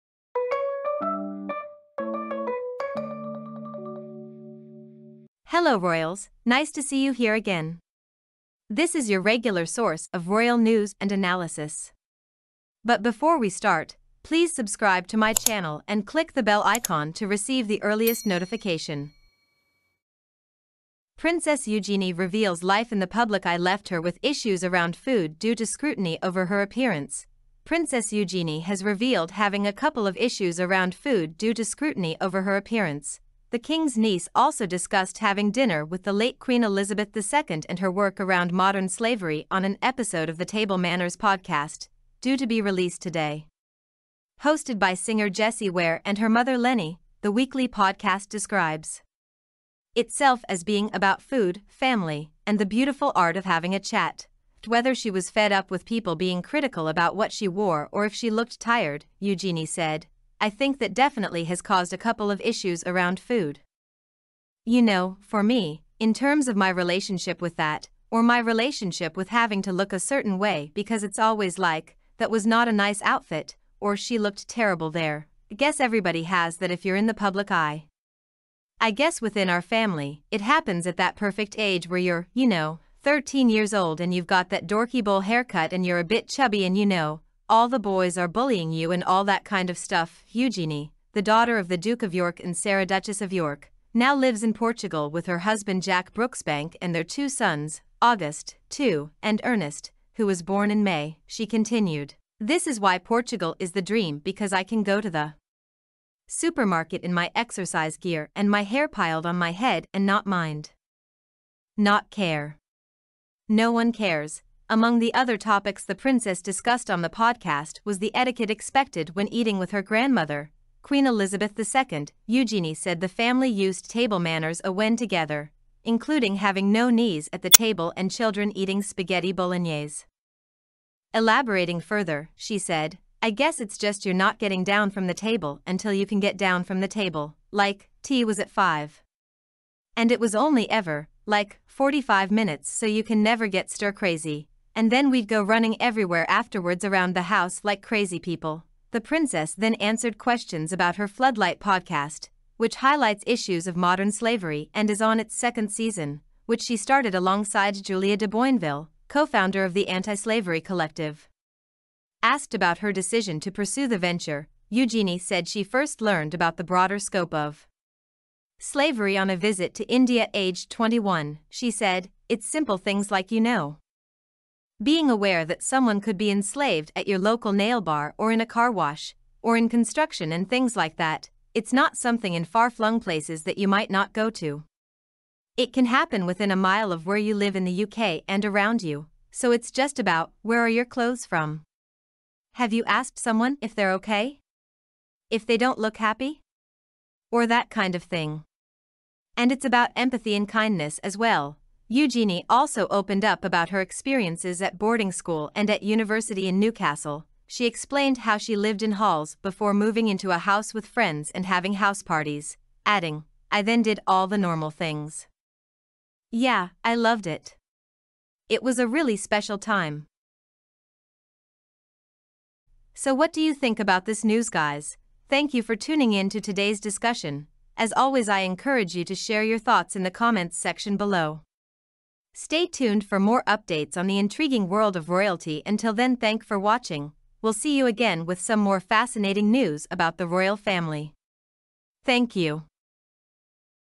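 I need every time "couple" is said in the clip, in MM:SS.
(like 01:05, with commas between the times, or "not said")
00:29, 01:01.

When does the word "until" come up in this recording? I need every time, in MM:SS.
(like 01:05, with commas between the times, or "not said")
02:15, 03:55.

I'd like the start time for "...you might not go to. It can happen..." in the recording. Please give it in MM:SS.
03:03.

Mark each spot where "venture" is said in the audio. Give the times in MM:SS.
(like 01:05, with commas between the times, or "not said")
02:43.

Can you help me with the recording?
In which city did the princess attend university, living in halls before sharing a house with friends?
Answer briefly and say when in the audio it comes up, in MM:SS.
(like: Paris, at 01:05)
Newcastle, at 03:26.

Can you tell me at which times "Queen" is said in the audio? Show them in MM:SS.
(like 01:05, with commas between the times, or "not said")
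00:36, 02:00.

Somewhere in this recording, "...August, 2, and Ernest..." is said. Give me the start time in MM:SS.
01:38.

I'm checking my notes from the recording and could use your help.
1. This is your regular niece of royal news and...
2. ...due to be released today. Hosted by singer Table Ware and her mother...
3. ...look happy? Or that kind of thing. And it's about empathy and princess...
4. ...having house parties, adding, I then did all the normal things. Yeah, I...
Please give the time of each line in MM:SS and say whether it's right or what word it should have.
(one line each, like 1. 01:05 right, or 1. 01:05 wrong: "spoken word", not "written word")
1. 00:08 wrong: "source", not "niece"
2. 00:42 wrong: "Jessie", not "Table"
3. 03:15 wrong: "kindness", not "princess"
4. 03:31 right.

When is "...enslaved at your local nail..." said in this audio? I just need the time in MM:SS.
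02:56.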